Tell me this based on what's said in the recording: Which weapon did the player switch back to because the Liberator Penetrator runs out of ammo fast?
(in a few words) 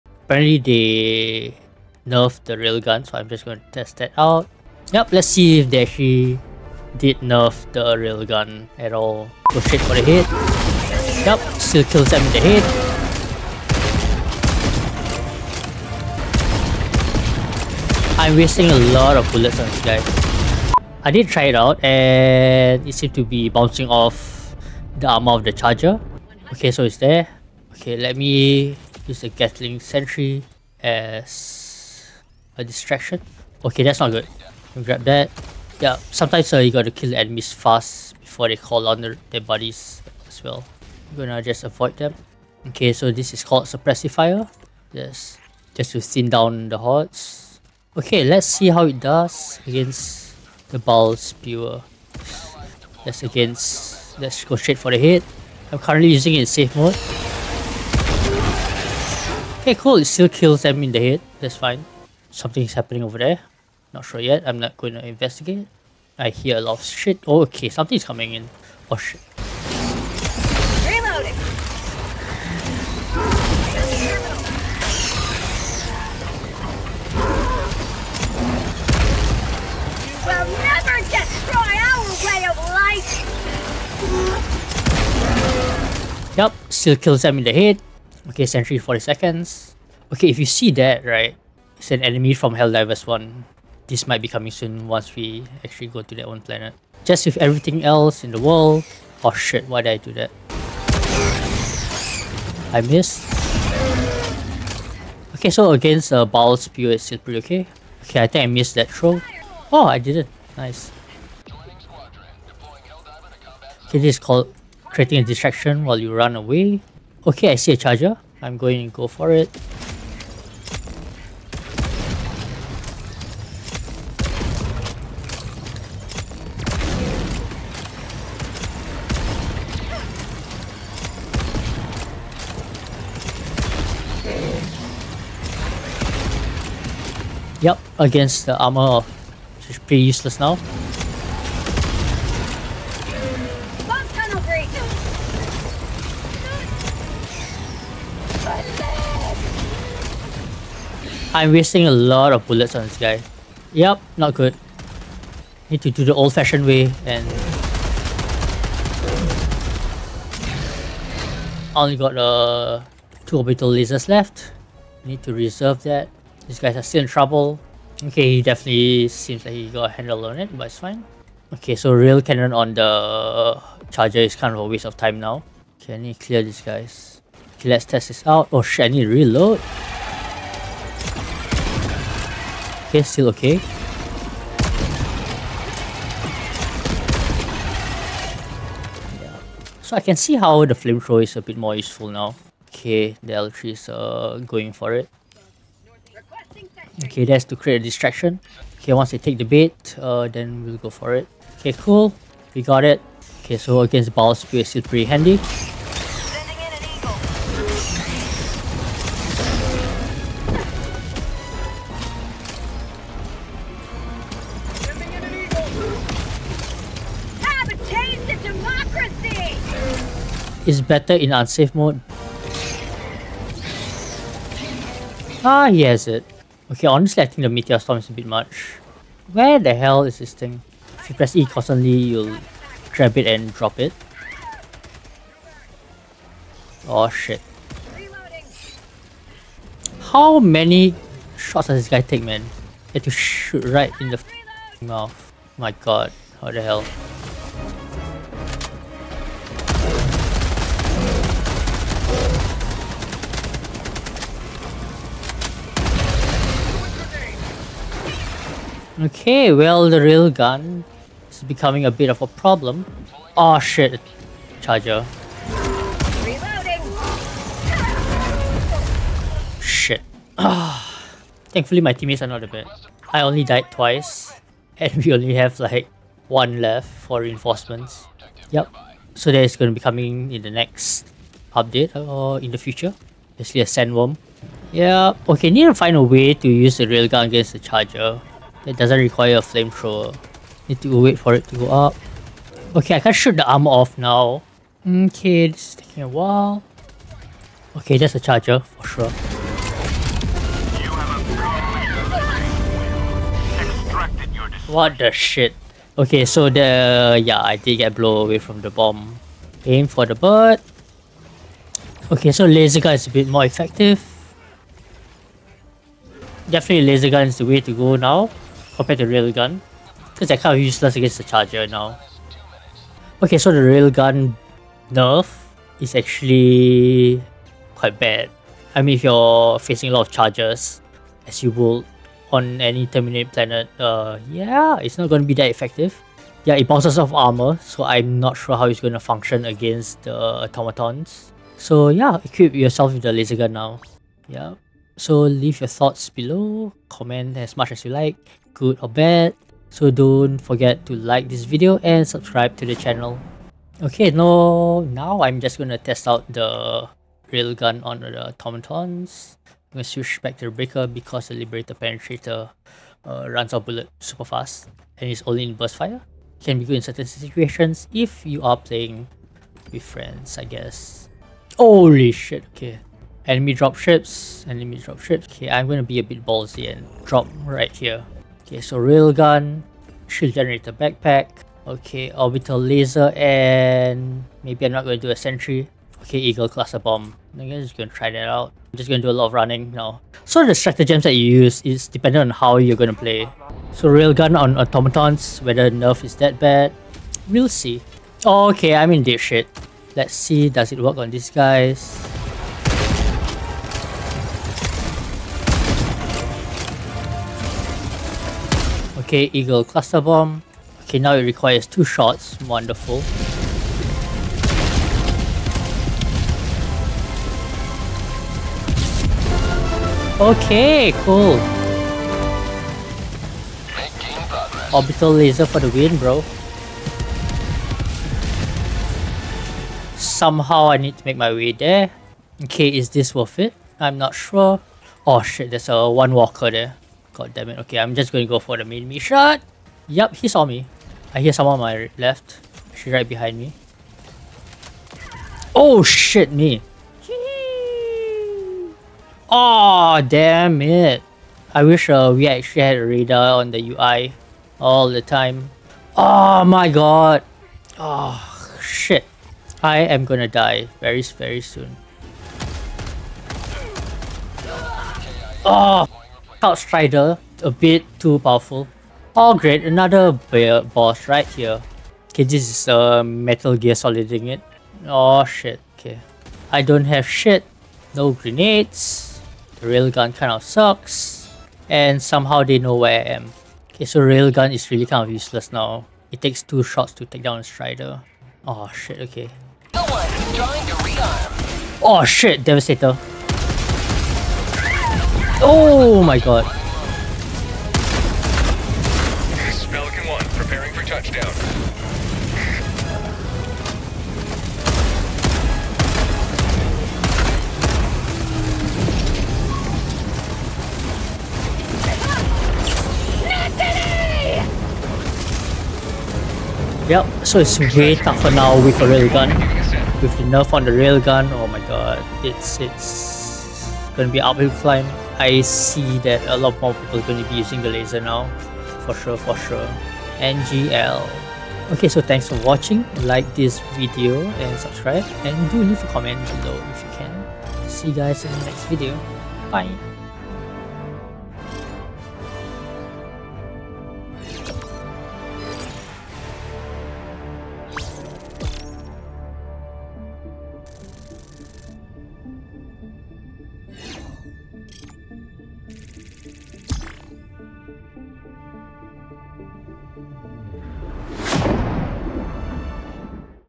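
Breaker.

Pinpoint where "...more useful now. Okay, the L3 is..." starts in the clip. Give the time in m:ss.
3:11.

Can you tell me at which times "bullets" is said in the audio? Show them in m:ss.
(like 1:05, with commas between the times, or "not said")
0:19, 2:32, 6:03.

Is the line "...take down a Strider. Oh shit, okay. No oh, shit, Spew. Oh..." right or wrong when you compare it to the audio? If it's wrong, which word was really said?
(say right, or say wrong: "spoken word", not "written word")
wrong: "Devastator", not "Spew".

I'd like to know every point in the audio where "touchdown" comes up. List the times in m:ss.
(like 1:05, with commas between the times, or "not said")
8:20.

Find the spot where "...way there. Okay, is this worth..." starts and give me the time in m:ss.
7:11.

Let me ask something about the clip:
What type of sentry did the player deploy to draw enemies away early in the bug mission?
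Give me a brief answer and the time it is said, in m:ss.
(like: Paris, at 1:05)
Gatling Sentry, at 0:29.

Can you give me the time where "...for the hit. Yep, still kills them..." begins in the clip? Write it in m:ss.
0:09.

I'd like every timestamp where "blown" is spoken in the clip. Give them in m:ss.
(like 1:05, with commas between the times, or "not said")
5:07.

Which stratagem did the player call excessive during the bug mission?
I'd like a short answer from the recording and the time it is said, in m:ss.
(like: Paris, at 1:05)
Meteor Storm, at 3:47.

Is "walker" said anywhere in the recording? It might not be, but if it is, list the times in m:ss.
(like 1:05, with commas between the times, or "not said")
7:16.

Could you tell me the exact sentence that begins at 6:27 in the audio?
I guess am just gonna try that out.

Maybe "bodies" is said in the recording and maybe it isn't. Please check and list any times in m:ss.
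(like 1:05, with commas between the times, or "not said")
0:39.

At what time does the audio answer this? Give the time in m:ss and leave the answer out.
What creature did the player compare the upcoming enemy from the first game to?
4:43.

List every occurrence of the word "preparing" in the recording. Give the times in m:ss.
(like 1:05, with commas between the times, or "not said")
8:20.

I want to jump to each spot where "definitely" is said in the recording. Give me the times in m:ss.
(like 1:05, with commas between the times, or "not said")
2:48, 5:16.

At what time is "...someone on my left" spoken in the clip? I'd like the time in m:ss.
7:21.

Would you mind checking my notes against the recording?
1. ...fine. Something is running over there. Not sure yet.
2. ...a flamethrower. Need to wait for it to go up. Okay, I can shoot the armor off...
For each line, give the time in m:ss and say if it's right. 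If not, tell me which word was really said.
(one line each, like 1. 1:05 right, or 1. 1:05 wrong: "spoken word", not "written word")
1. 1:01 wrong: "happening", not "running"
2. 4:49 right.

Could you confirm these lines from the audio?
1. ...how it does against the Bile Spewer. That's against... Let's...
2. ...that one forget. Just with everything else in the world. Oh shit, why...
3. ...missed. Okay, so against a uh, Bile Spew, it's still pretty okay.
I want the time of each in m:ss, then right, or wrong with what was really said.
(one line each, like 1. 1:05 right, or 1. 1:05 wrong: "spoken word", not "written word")
1. 0:48 right
2. 1:36 wrong: "planet", not "forget"
3. 1:42 right.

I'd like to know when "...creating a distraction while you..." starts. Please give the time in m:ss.
1:54.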